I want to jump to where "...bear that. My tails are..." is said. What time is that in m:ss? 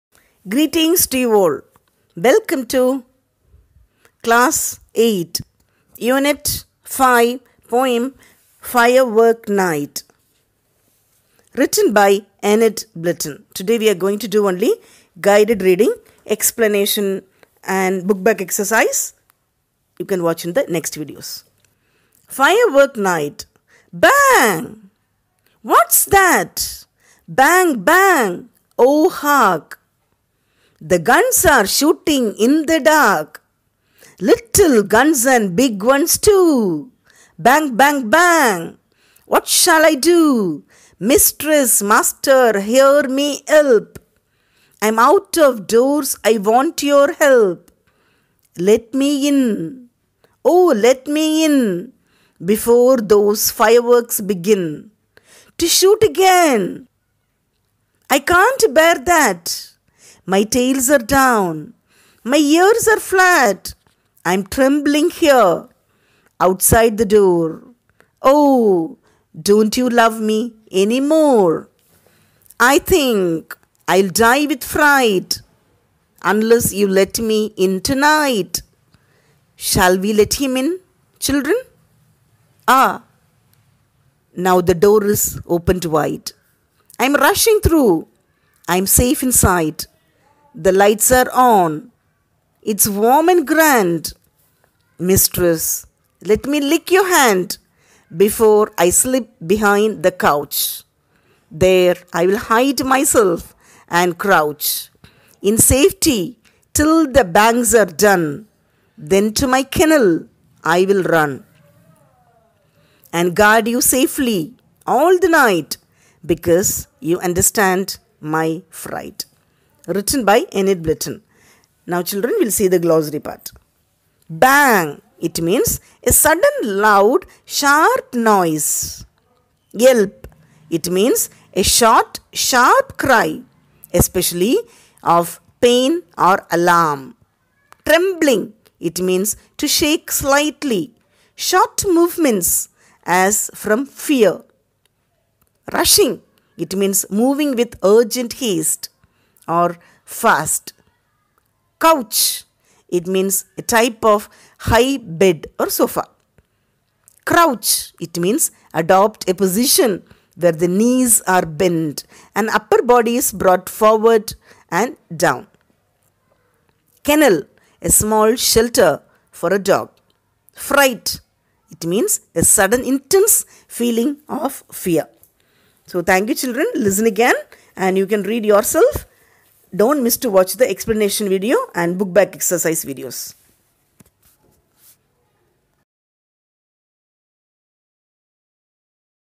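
0:58.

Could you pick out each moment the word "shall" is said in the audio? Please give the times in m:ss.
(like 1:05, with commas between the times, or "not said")
0:39, 1:19.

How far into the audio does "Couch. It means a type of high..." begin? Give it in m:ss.
2:31.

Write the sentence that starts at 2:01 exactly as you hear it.
Now, children, we'll see the glossary part.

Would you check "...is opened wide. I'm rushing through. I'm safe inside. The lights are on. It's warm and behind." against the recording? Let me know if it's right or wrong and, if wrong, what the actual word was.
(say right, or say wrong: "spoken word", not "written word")
wrong: "grand", not "behind".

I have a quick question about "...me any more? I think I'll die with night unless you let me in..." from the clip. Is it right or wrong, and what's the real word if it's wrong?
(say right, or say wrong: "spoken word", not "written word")
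wrong: "fright", not "night".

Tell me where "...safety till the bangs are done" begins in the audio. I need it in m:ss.
1:45.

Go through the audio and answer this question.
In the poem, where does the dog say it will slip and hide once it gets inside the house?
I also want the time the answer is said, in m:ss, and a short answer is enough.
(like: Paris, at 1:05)
behind the couch, at 1:39.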